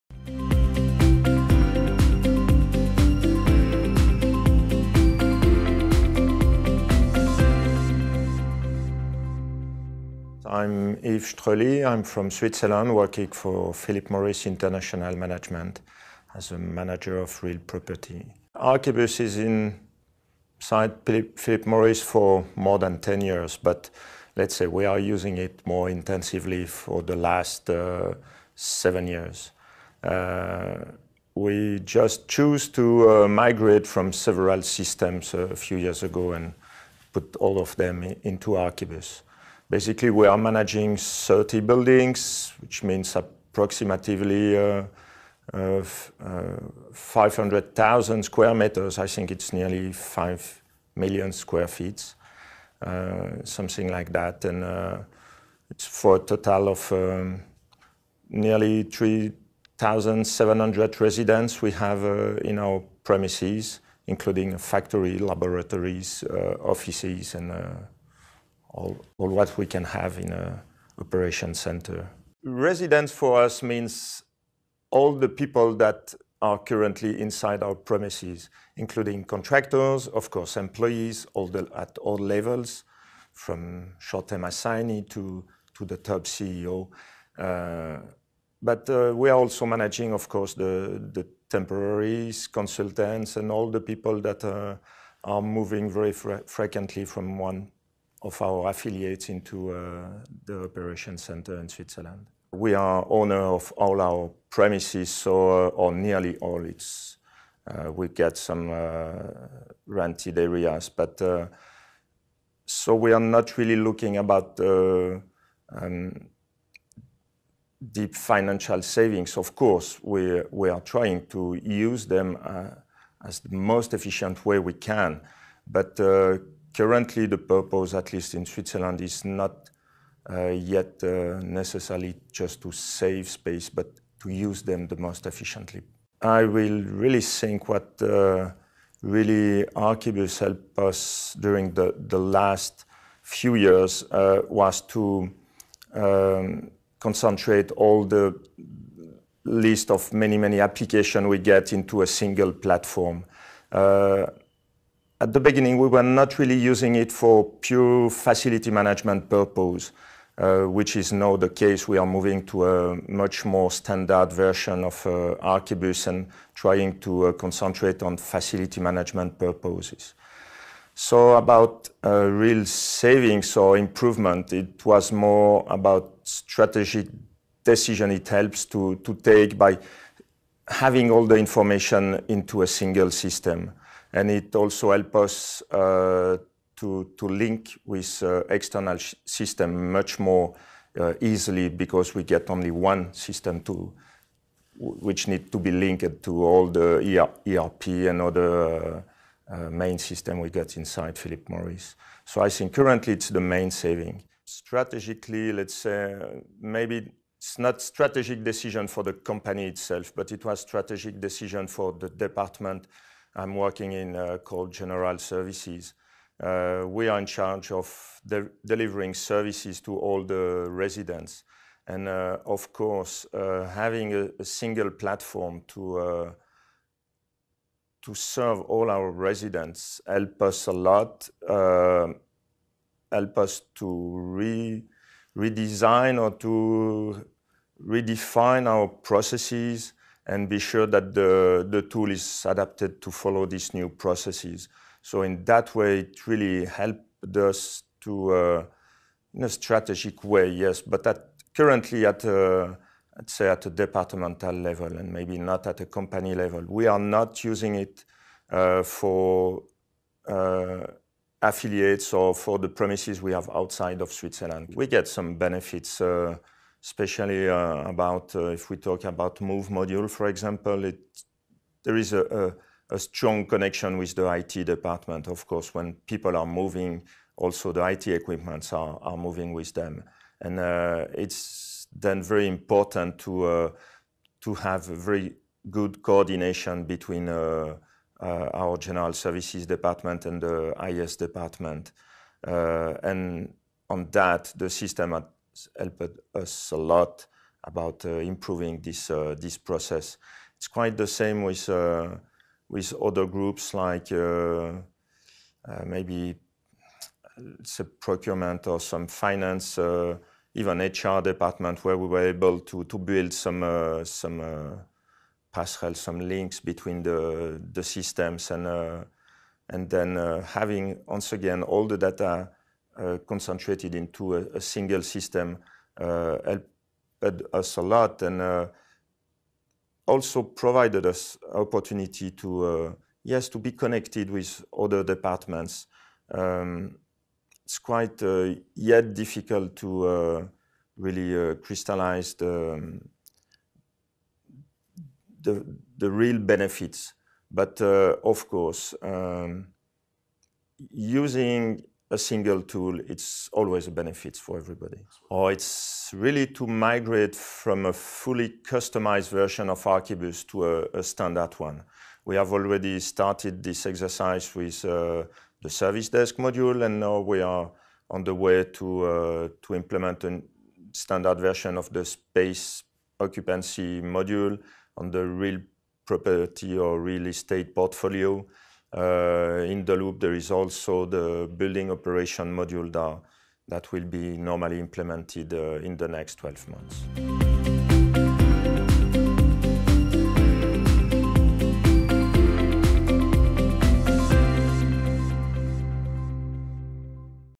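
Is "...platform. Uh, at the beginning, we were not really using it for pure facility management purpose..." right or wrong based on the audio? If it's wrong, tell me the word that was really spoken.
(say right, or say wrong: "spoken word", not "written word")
right.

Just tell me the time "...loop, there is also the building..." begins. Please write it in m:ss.
6:19.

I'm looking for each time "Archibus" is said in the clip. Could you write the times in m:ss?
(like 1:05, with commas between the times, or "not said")
0:18, 0:38, 2:19, 2:45, 5:59.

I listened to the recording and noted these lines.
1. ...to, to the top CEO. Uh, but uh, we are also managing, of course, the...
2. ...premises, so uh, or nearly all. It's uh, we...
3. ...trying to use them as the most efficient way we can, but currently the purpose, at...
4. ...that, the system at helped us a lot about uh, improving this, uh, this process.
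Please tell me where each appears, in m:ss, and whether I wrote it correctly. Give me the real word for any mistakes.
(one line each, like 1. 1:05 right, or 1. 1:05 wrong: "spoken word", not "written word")
1. 1:25 right
2. 1:44 right
3. 2:00 right
4. 4:54 right.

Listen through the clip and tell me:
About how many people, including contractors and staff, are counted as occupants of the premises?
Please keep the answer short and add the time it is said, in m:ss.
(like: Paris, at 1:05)
3,700, at 0:58.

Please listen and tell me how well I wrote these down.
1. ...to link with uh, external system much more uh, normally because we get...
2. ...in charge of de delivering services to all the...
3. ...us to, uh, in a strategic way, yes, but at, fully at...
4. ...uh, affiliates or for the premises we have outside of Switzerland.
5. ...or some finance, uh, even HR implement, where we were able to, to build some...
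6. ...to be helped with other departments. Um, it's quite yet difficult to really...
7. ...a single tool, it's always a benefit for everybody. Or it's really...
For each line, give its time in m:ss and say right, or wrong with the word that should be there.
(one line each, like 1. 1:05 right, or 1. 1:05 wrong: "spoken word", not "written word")
1. 3:07 wrong: "easily", not "normally"
2. 3:37 right
3. 4:07 wrong: "currently", not "fully"
4. 4:20 right
5. 5:08 wrong: "department", not "implement"
6. 5:33 wrong: "connected", not "helped"
7. 5:52 right.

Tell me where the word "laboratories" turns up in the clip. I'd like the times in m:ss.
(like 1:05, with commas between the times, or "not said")
1:05.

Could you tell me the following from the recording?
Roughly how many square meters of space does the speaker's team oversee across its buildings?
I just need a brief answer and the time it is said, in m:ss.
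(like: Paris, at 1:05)
500,000, at 0:46.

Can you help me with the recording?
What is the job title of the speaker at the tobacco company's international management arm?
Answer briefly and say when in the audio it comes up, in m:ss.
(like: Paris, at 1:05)
Manager of real property, at 0:16.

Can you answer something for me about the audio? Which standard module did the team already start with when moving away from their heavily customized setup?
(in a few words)
Service desk module.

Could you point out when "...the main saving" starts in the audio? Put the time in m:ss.
3:23.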